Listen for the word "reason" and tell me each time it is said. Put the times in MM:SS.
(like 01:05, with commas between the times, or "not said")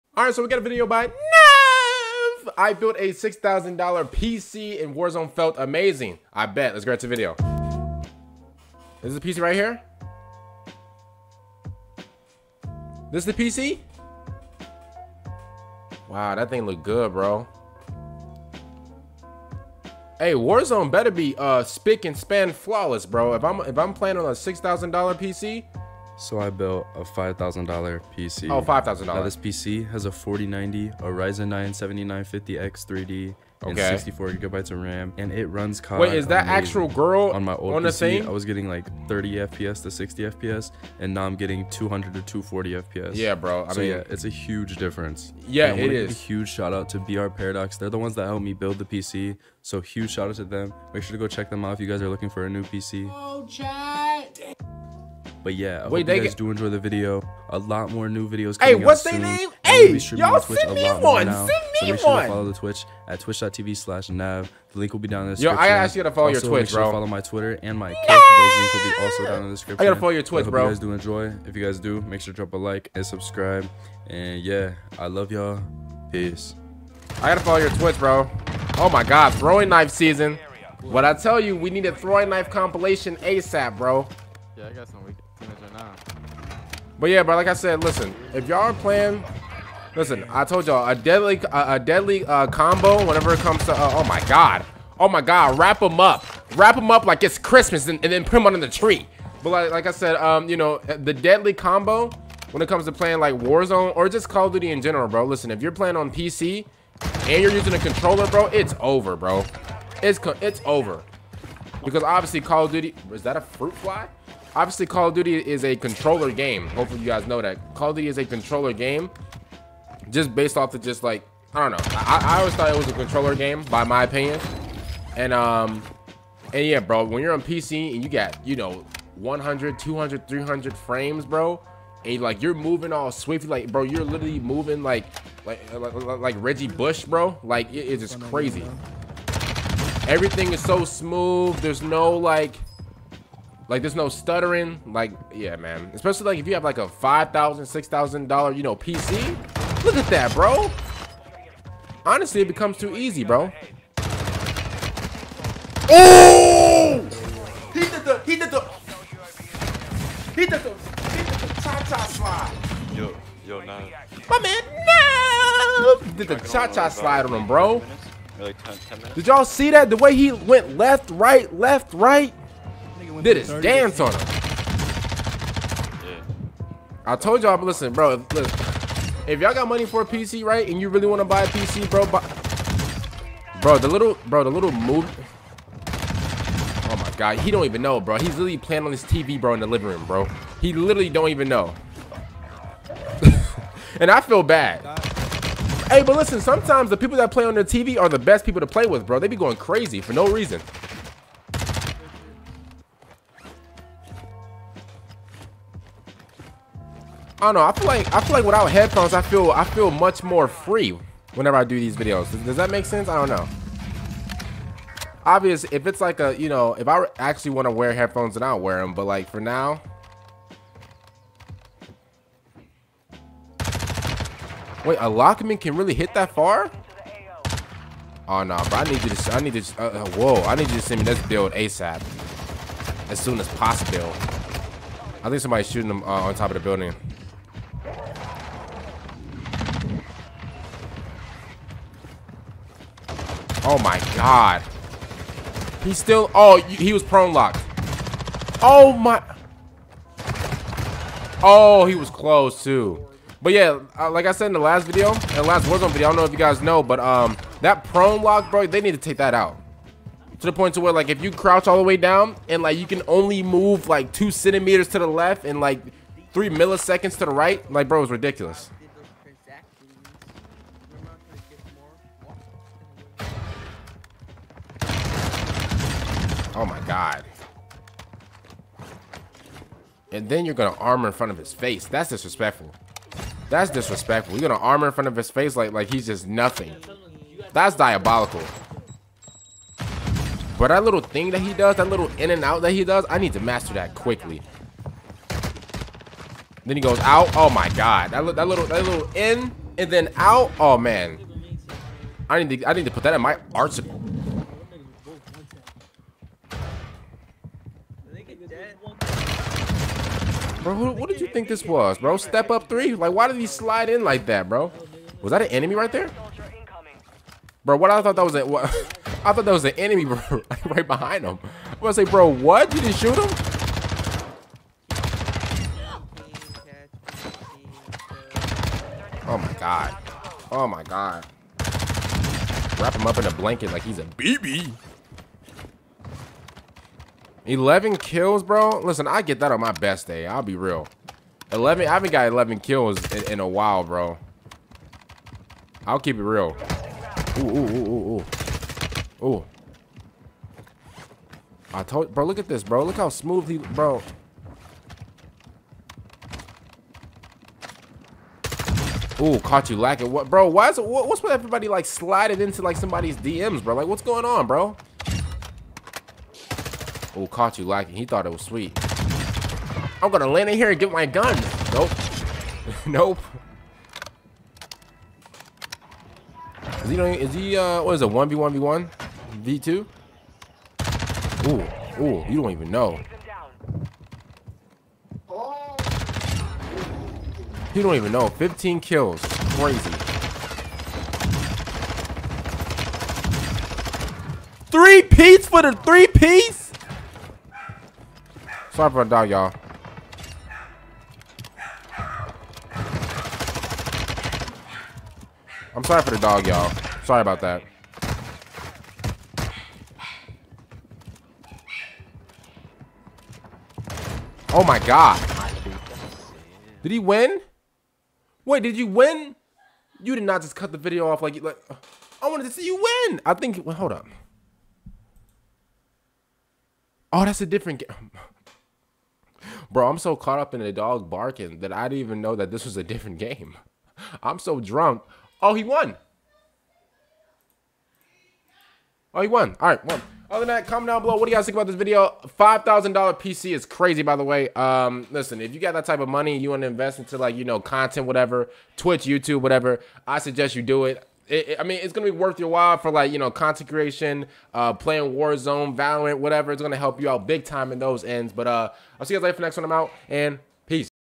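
03:20.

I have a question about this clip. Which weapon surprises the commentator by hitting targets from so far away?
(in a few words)
Lachmann.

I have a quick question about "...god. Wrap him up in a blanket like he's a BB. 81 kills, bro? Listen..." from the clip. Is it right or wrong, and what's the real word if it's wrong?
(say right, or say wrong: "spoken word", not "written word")
wrong: "11", not "81".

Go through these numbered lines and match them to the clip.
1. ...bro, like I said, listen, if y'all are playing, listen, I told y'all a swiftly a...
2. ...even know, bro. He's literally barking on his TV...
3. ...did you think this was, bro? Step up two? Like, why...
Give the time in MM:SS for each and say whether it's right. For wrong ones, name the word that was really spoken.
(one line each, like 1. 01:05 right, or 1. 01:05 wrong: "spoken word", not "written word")
1. 01:27 wrong: "deadly", not "swiftly"
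2. 03:07 wrong: "playing", not "barking"
3. 05:11 wrong: "three", not "two".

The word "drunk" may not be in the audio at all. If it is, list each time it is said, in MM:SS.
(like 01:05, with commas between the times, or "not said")
07:14.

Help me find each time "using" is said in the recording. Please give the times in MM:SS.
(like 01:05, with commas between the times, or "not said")
01:47.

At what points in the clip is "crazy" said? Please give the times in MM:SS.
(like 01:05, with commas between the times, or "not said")
02:18, 03:19, 06:29, 07:23.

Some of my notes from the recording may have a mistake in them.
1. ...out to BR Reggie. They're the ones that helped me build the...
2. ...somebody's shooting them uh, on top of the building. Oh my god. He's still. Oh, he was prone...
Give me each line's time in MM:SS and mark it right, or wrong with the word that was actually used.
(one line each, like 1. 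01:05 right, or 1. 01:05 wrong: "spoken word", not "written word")
1. 00:46 wrong: "Paradox", not "Reggie"
2. 03:55 right.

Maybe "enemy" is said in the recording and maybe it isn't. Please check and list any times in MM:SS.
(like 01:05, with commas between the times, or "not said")
05:15, 05:19.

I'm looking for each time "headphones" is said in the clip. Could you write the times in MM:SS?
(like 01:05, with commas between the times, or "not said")
03:28, 03:37.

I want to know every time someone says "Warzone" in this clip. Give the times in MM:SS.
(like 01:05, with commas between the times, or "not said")
00:04, 00:20, 01:43, 04:15, 07:35.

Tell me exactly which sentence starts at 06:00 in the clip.
What, what's with everybody like sliding into like somebody's DMs, bro?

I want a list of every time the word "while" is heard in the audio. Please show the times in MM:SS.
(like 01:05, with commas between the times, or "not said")
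05:43, 07:32.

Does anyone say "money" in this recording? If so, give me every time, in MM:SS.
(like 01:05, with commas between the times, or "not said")
02:59, 07:26.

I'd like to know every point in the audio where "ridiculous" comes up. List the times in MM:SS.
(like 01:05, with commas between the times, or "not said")
04:28.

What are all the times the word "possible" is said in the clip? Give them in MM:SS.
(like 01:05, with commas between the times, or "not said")
03:53.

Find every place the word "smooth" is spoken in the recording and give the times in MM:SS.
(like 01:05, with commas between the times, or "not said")
02:20, 05:53.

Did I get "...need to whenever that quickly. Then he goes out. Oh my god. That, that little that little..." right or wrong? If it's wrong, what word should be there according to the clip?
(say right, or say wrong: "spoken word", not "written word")
wrong: "master", not "whenever".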